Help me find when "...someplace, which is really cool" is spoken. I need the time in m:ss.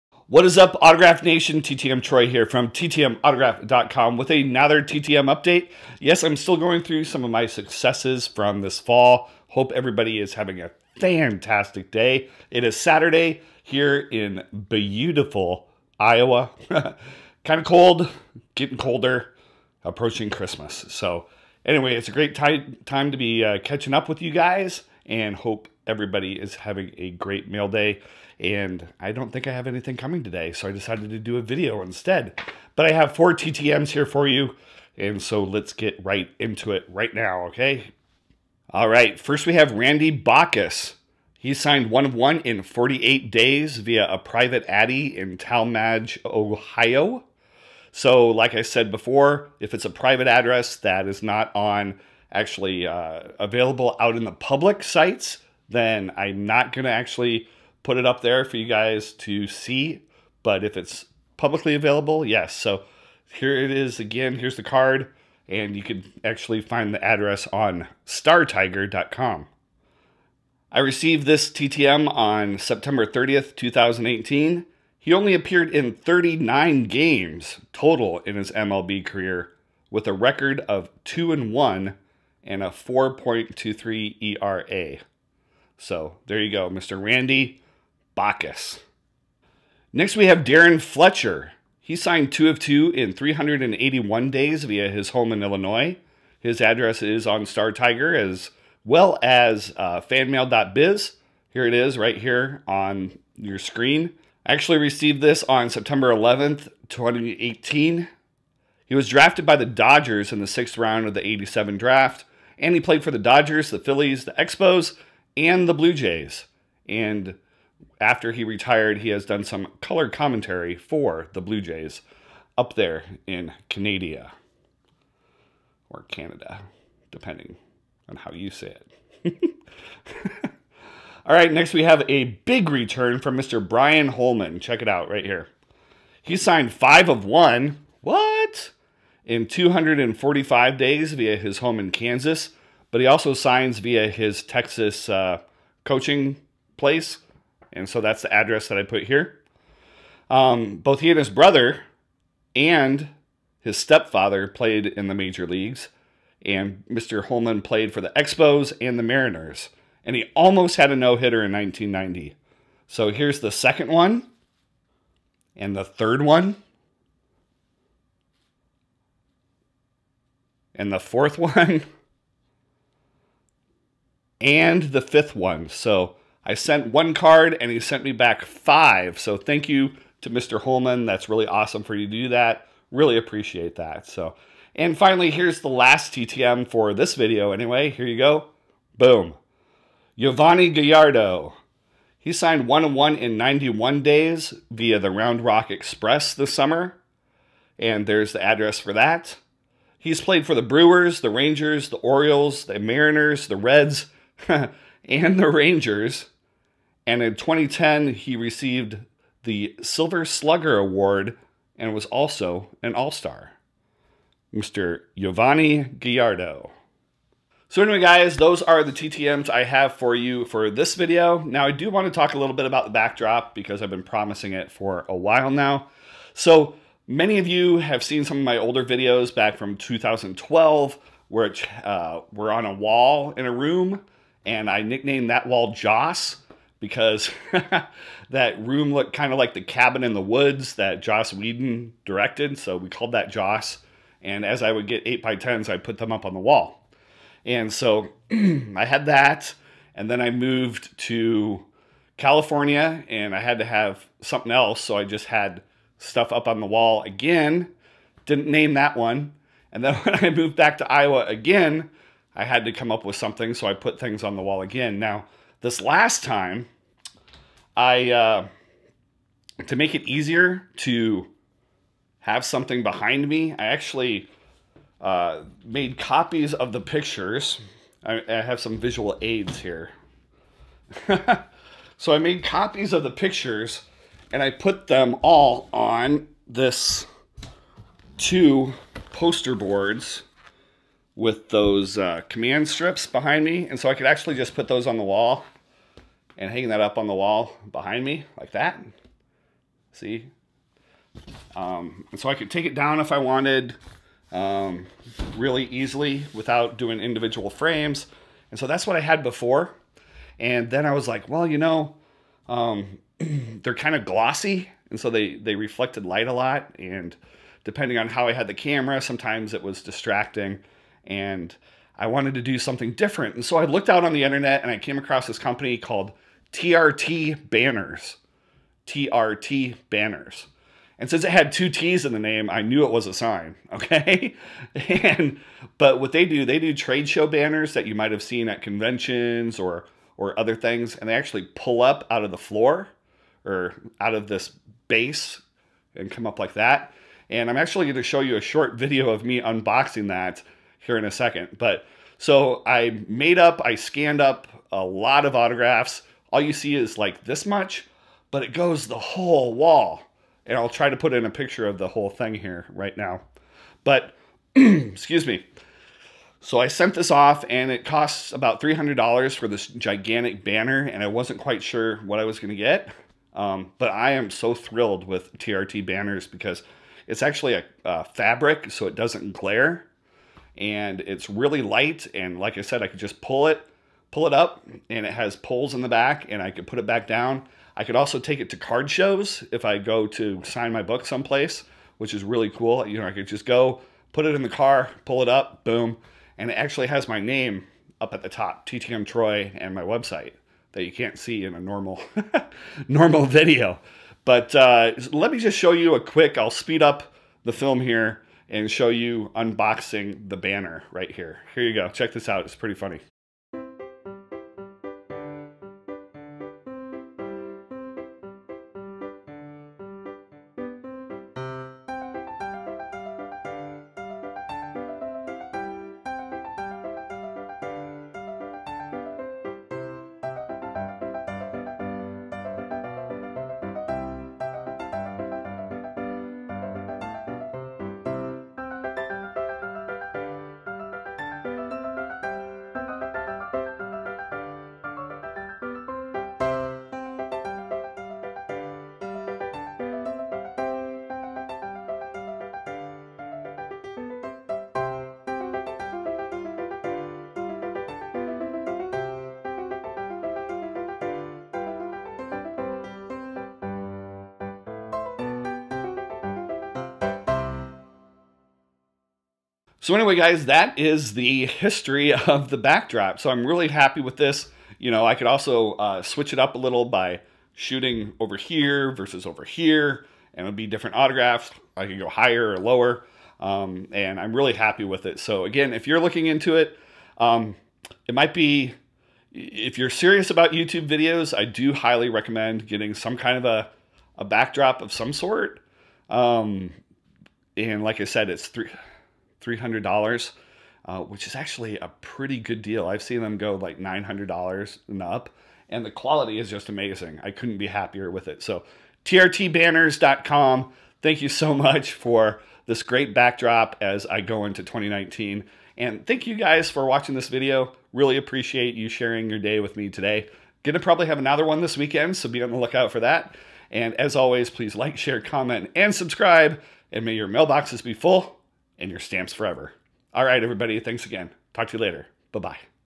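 6:31.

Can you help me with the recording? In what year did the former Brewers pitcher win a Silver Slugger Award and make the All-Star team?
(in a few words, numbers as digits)
2010.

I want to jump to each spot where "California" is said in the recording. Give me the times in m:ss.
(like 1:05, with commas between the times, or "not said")
4:12.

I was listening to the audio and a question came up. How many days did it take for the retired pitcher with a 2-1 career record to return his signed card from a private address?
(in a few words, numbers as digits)
48.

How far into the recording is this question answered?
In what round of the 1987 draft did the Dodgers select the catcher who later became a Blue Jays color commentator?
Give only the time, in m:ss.
1:50.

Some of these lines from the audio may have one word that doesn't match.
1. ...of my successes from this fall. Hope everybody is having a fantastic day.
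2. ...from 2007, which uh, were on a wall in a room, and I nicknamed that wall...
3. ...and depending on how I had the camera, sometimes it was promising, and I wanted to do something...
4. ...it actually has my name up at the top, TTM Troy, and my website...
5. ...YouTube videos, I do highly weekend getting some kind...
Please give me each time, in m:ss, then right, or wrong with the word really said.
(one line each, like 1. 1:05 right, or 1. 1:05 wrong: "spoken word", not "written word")
1. 0:07 right
2. 3:49 wrong: "2012", not "2007"
3. 5:16 wrong: "distracting", not "promising"
4. 6:36 right
5. 8:10 wrong: "recommend", not "weekend".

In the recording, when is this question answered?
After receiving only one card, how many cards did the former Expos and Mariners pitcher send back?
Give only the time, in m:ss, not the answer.
2:16.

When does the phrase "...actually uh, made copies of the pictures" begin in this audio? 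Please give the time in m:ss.
4:33.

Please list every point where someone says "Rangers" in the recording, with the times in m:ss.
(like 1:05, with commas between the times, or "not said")
3:21, 3:25.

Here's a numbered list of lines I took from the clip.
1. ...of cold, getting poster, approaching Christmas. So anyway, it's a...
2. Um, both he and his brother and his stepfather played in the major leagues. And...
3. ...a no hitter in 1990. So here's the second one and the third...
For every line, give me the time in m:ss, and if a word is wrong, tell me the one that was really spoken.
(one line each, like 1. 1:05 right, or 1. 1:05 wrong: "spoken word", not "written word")
1. 0:17 wrong: "colder", not "poster"
2. 2:30 right
3. 2:40 right.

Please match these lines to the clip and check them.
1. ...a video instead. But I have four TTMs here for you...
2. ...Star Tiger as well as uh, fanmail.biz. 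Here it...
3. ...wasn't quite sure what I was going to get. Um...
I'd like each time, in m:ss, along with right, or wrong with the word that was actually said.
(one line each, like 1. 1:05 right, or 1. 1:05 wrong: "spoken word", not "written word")
1. 0:31 right
2. 1:37 right
3. 6:11 right.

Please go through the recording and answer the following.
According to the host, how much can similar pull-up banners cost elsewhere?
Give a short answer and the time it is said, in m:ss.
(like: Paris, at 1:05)
$900 and up, at 8:23.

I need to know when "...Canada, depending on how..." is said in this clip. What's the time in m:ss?
2:06.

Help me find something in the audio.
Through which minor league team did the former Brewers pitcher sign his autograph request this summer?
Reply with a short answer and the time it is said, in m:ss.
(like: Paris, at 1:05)
Round Rock Express, at 3:15.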